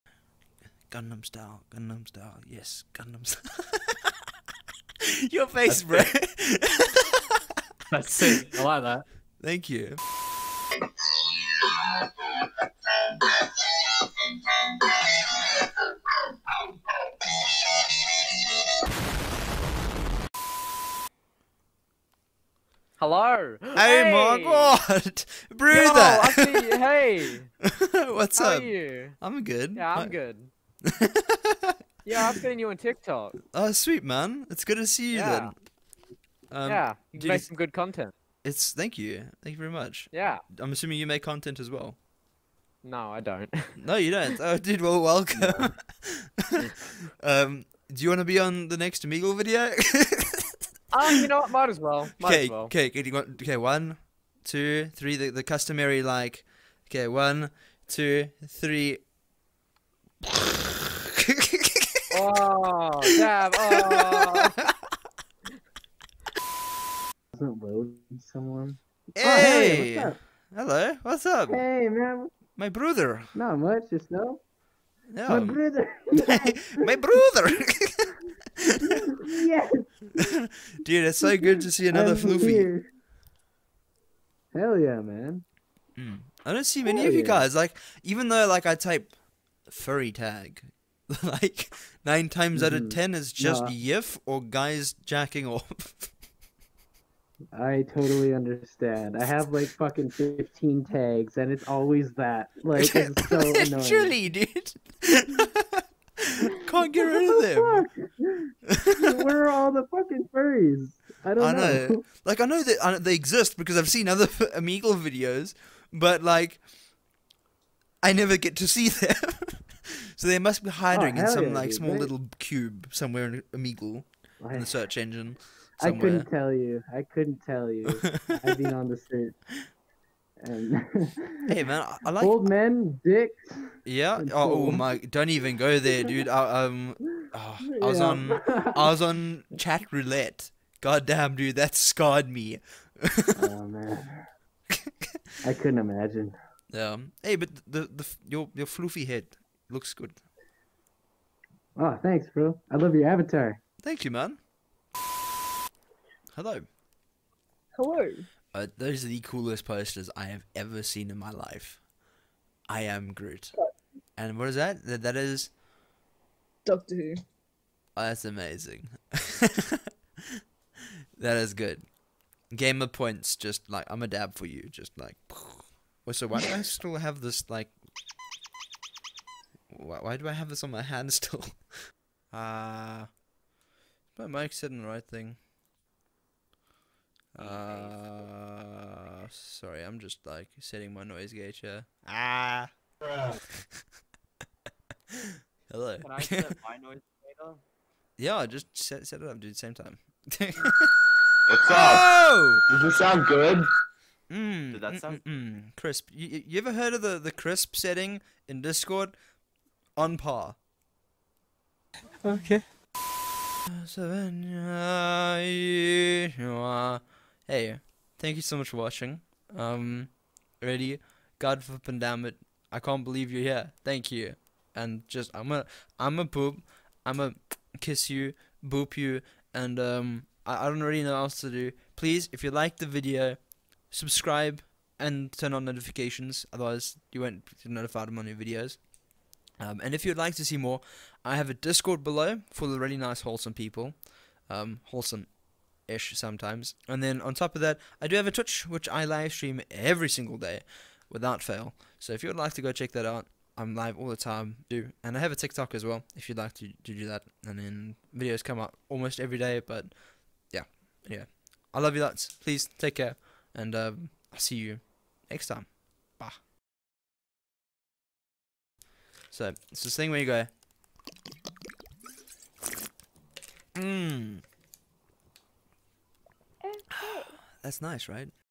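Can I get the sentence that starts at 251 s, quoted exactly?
So if you would like to go check that out, I'm live all the time.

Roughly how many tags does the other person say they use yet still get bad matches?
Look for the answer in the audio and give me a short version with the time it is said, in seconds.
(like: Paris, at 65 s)
15, at 100 s.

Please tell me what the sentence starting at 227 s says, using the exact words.
I'm a kiss you, boop you, and um, I, I don't really know what else to do.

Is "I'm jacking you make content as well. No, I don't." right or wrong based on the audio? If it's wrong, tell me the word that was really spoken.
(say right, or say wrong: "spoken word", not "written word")
wrong: "assuming", not "jacking".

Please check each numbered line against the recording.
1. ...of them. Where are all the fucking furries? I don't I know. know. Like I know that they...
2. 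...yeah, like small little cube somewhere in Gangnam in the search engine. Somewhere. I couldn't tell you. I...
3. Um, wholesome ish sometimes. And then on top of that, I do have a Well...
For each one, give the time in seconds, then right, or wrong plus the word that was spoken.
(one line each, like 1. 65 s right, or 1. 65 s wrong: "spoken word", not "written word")
1. 107 s right
2. 121 s wrong: "Omegle", not "Gangnam"
3. 244 s wrong: "Twitch", not "Well".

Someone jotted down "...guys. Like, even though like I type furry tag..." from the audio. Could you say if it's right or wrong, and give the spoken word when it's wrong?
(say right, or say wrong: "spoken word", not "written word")
right.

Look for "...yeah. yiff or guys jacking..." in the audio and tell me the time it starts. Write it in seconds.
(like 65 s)
93 s.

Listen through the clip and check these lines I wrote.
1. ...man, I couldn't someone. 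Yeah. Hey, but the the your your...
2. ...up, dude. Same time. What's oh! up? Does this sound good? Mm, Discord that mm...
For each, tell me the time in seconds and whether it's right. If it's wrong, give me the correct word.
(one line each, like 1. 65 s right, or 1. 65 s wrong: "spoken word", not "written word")
1. 143 s wrong: "imagine", not "someone"
2. 199 s wrong: "Did", not "Discord".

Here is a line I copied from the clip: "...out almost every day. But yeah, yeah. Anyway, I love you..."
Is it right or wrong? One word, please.
right.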